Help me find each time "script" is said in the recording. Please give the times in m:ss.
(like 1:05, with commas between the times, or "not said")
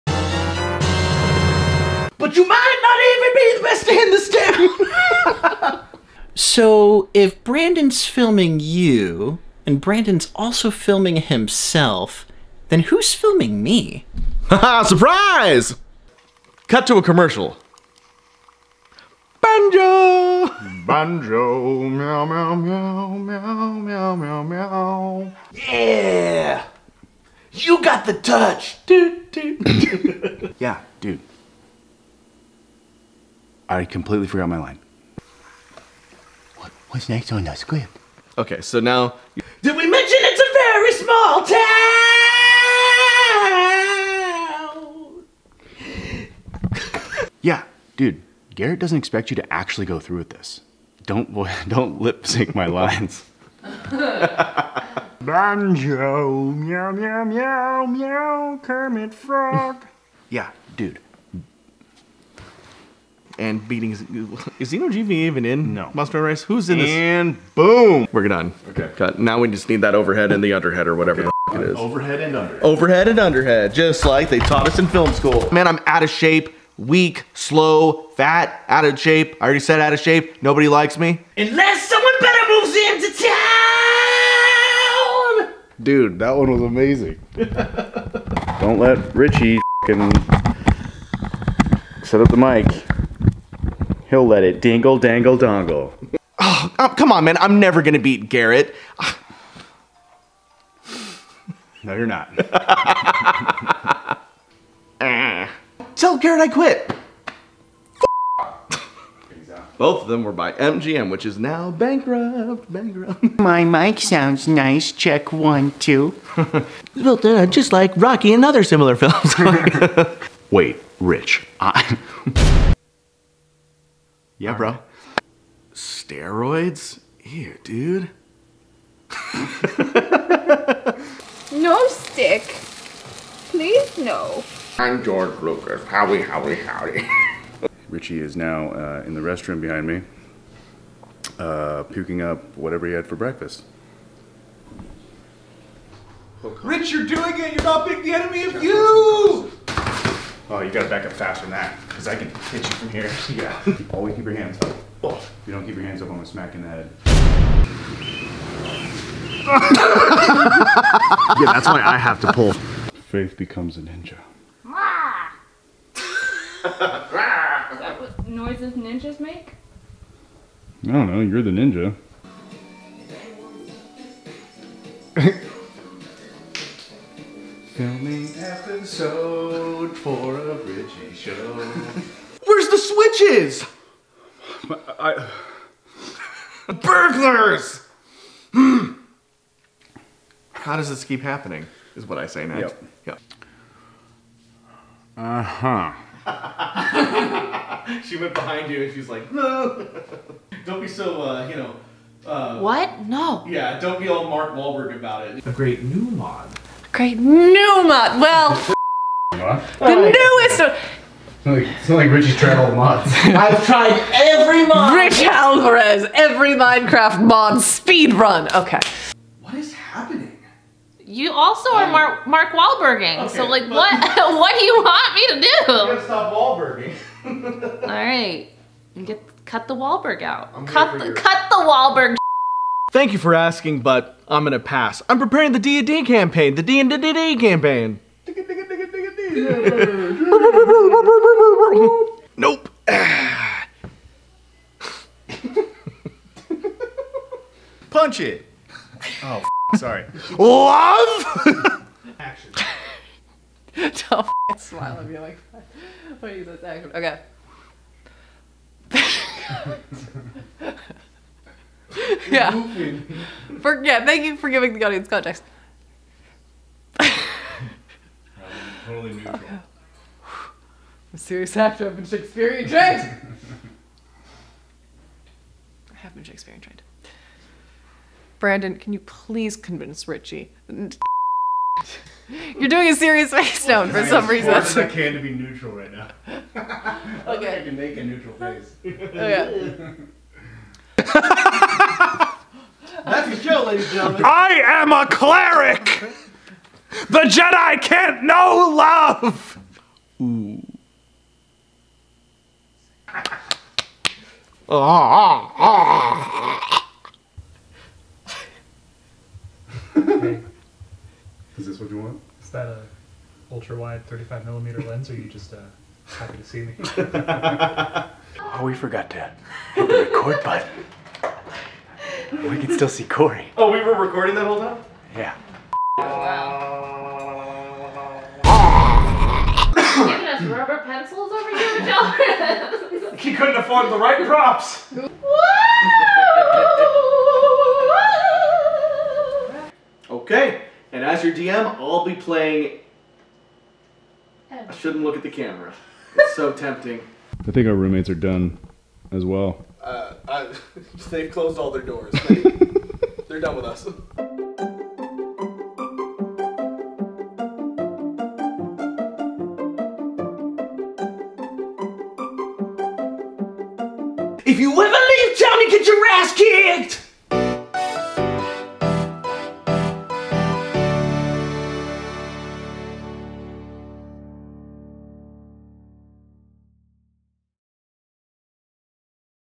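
0:37.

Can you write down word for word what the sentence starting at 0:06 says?
so if Brandon's filming you and Brandon's also filming himself, then who's filming me?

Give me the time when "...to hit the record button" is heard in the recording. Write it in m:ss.
5:19.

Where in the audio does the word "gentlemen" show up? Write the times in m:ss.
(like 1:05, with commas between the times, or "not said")
4:53.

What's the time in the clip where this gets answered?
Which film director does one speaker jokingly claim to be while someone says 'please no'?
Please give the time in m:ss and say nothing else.
2:15.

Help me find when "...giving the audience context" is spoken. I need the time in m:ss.
4:24.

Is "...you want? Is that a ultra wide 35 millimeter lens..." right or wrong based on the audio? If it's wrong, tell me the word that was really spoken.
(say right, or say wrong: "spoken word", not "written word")
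right.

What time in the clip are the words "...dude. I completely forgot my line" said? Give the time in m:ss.
0:31.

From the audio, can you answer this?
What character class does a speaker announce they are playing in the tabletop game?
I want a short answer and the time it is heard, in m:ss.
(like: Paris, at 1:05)
cleric, at 4:55.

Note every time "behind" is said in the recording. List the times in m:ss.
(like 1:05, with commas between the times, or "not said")
2:19, 3:18.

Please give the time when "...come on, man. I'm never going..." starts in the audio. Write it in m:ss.
1:36.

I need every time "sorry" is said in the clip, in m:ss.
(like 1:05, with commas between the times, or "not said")
4:09.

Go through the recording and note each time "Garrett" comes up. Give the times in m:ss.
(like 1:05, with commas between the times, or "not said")
0:48, 1:38, 1:46.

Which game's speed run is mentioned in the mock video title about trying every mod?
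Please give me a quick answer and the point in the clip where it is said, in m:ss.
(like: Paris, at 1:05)
Minecraft, at 3:36.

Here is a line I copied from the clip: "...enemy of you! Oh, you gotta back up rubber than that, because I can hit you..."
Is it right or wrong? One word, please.
wrong.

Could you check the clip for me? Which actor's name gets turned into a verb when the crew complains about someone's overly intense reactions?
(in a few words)
Mark Wahlberg.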